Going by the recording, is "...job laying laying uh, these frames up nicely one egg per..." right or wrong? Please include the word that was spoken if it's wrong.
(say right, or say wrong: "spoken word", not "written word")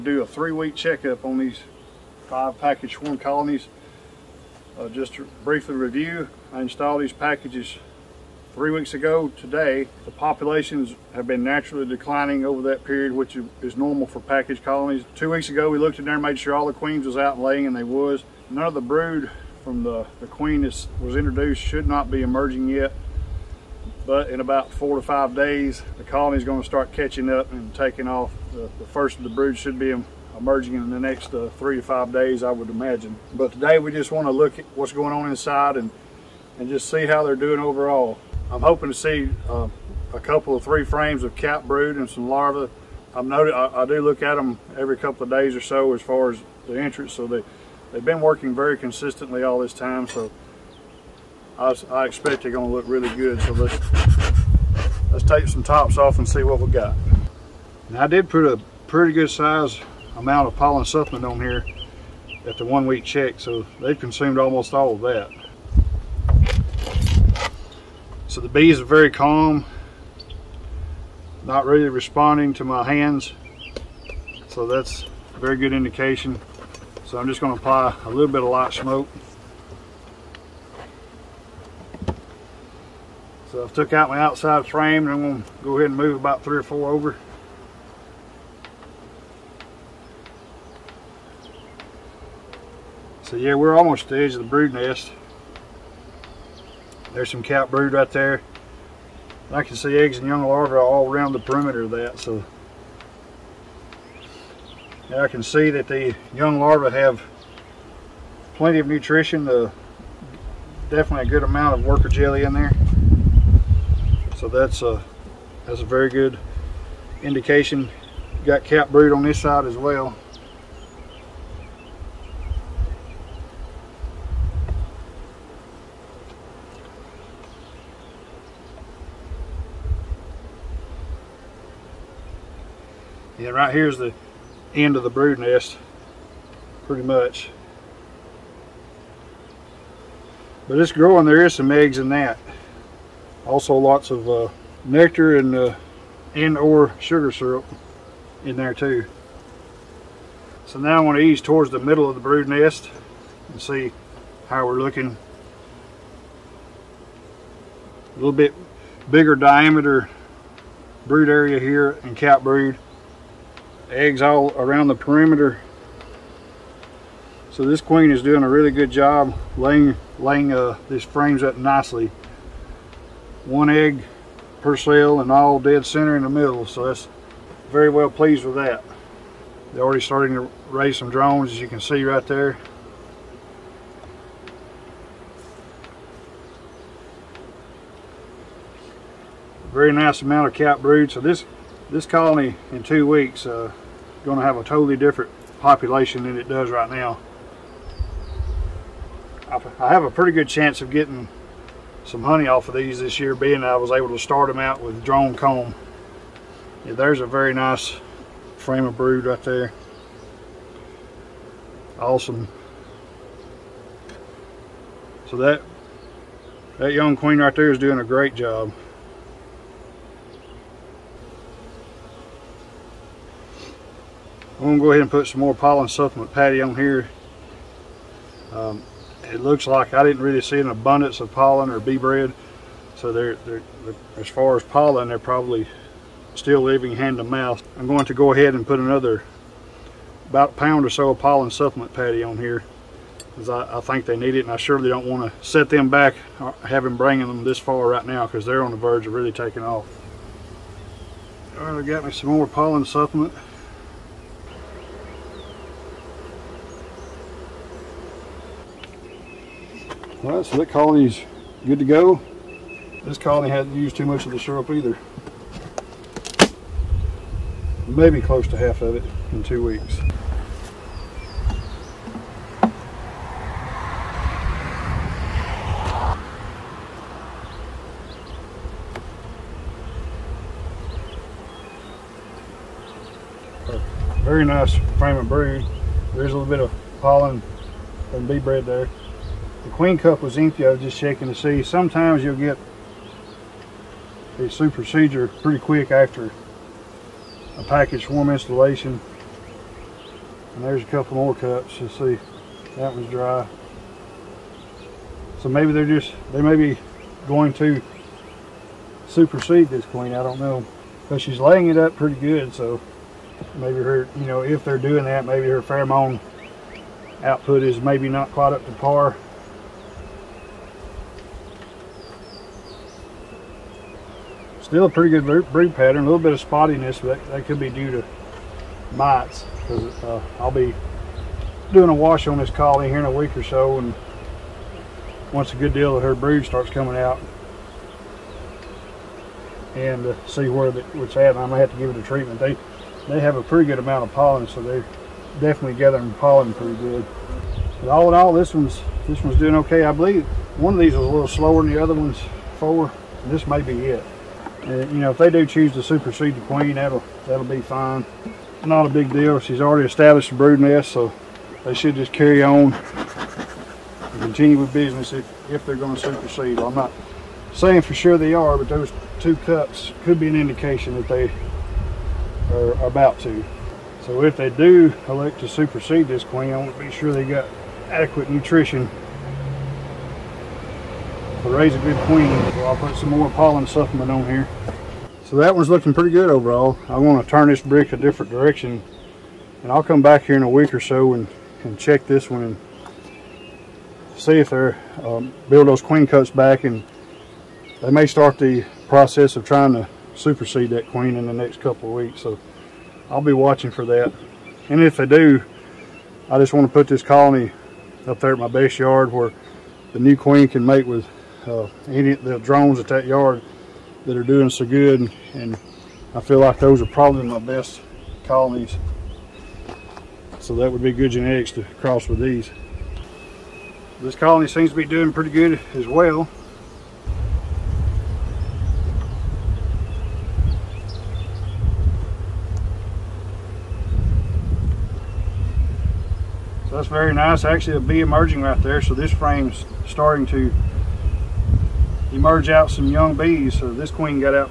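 right.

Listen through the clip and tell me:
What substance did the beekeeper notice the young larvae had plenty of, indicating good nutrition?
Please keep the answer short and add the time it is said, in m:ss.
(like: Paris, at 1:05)
worker jelly, at 1:51.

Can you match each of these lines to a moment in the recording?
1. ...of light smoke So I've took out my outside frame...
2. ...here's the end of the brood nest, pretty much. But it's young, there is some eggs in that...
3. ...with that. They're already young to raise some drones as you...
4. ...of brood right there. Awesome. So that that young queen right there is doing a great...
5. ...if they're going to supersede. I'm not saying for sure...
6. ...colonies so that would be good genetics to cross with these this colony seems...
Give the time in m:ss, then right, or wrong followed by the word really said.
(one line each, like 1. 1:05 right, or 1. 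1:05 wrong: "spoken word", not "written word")
1. 1:18 right
2. 2:13 wrong: "growing", not "young"
3. 2:58 wrong: "starting", not "young"
4. 3:28 right
5. 6:05 right
6. 6:58 right.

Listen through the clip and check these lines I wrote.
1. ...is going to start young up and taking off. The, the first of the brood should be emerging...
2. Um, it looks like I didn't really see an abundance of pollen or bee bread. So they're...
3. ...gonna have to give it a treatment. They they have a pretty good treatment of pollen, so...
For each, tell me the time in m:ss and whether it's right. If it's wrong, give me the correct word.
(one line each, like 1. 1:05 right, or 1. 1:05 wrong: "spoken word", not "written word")
1. 0:26 wrong: "catching", not "young"
2. 3:48 right
3. 5:41 wrong: "amount", not "treatment".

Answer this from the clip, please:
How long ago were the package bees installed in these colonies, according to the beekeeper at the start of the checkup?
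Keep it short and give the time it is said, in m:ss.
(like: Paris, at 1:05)
3 weeks, at 0:08.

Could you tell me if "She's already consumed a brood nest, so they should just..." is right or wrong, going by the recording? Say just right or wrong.
wrong.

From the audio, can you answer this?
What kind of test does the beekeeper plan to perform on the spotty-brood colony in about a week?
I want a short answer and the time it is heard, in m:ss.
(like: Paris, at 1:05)
a wash, at 5:31.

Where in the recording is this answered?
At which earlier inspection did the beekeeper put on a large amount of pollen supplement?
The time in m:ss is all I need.
1:02.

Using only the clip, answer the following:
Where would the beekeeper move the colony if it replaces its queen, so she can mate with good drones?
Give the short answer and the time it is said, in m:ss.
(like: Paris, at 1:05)
base yard, at 6:48.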